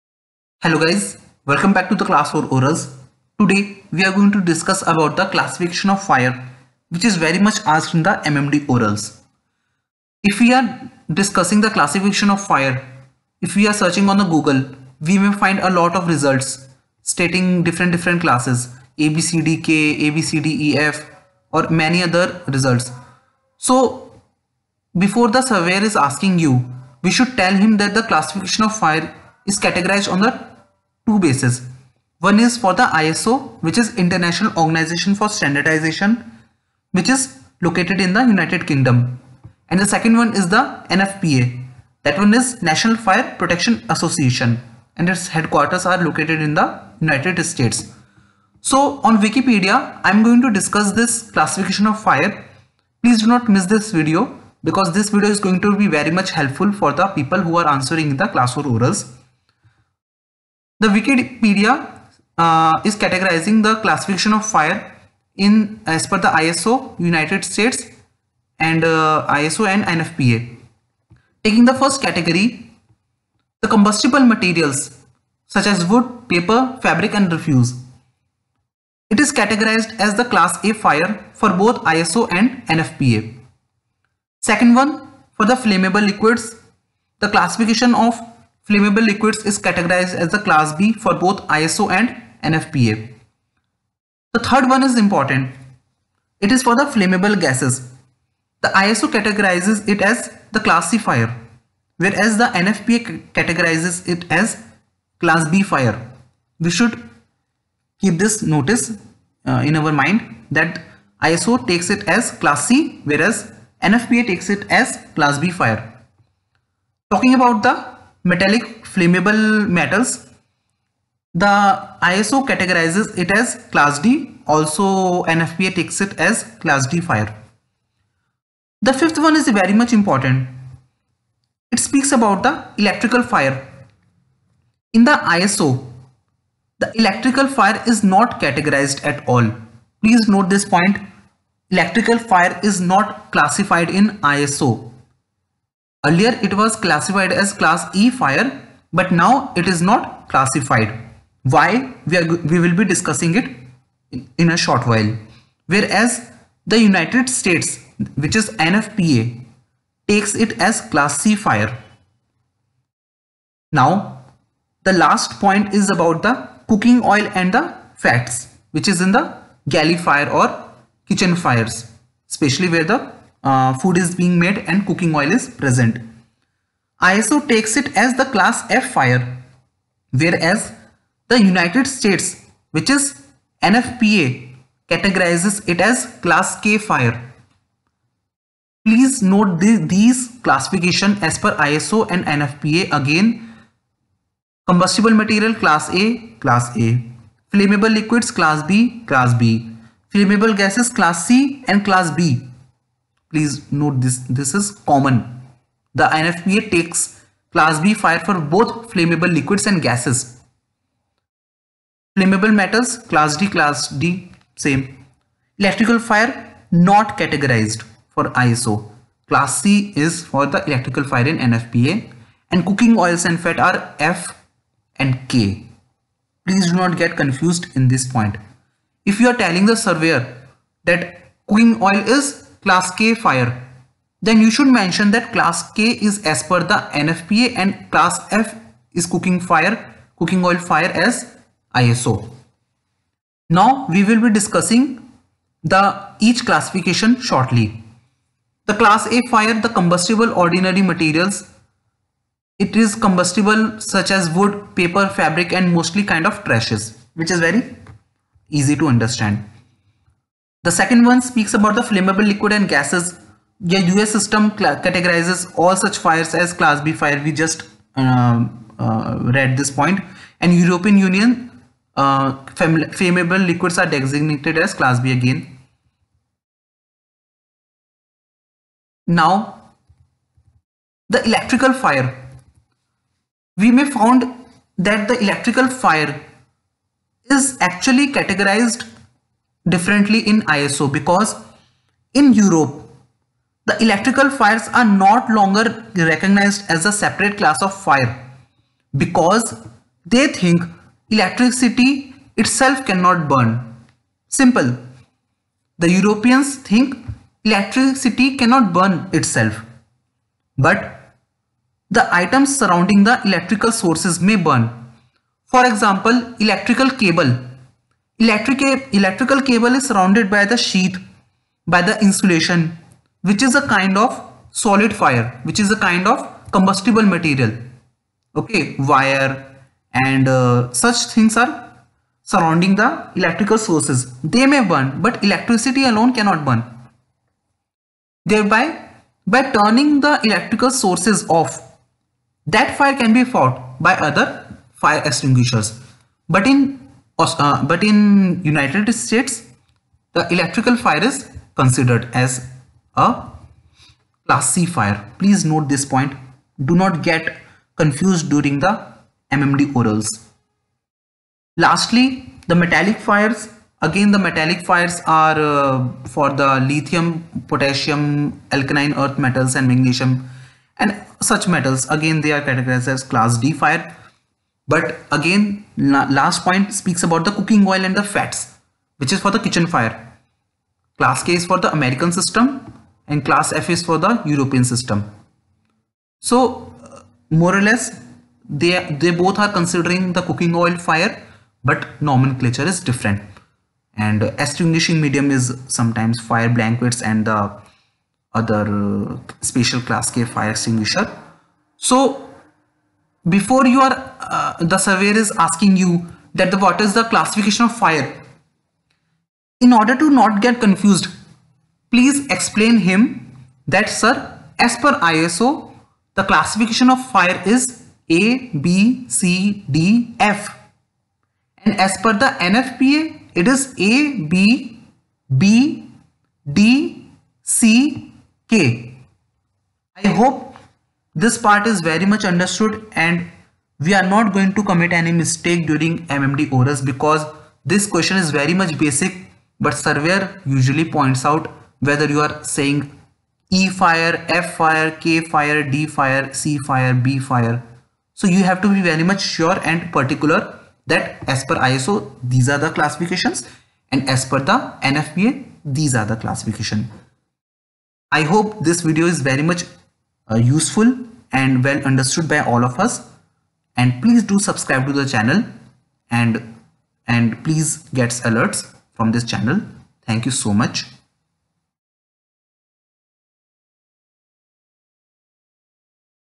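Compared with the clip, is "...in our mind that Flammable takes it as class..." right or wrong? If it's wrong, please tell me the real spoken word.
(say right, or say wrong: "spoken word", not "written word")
wrong: "ISO", not "Flammable".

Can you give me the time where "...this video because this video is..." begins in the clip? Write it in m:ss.
0:53.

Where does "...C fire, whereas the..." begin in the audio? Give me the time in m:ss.
1:40.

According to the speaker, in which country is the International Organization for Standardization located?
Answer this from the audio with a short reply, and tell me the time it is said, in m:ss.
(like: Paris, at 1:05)
United Kingdom, at 0:38.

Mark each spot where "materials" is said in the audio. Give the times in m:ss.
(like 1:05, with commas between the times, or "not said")
1:14, 3:15, 4:10, 5:27.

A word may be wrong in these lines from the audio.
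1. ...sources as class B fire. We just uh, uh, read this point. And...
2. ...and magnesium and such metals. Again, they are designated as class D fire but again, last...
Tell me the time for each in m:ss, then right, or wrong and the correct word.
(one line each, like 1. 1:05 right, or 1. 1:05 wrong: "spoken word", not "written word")
1. 4:25 wrong: "fires", not "sources"
2. 6:09 wrong: "categorized", not "designated".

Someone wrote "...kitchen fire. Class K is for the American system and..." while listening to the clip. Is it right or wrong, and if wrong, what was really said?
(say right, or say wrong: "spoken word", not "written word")
right.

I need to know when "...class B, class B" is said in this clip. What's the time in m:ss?
3:18.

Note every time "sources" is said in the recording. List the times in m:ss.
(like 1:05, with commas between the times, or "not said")
5:13, 5:33, 5:40.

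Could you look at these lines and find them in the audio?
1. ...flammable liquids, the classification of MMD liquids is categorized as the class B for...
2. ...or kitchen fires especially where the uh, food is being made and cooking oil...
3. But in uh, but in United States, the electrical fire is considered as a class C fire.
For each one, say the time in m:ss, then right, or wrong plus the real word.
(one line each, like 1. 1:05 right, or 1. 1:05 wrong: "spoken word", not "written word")
1. 1:25 wrong: "Flammable", not "MMD"
2. 2:50 right
3. 5:46 right.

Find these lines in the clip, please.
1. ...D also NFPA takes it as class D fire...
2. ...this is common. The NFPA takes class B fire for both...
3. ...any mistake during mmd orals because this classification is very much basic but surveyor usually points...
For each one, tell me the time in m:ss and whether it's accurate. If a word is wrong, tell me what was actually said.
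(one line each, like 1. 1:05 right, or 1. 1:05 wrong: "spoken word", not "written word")
1. 2:03 right
2. 3:24 right
3. 7:14 wrong: "question", not "classification".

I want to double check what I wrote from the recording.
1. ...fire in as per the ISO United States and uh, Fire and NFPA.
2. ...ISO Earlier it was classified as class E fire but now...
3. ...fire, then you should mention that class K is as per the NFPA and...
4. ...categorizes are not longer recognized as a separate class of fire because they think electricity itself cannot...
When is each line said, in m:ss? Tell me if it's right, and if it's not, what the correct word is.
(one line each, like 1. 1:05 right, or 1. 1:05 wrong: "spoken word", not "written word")
1. 1:04 wrong: "ISO", not "Fire"
2. 2:24 right
3. 3:53 right
4. 4:54 wrong: "fires", not "categorizes".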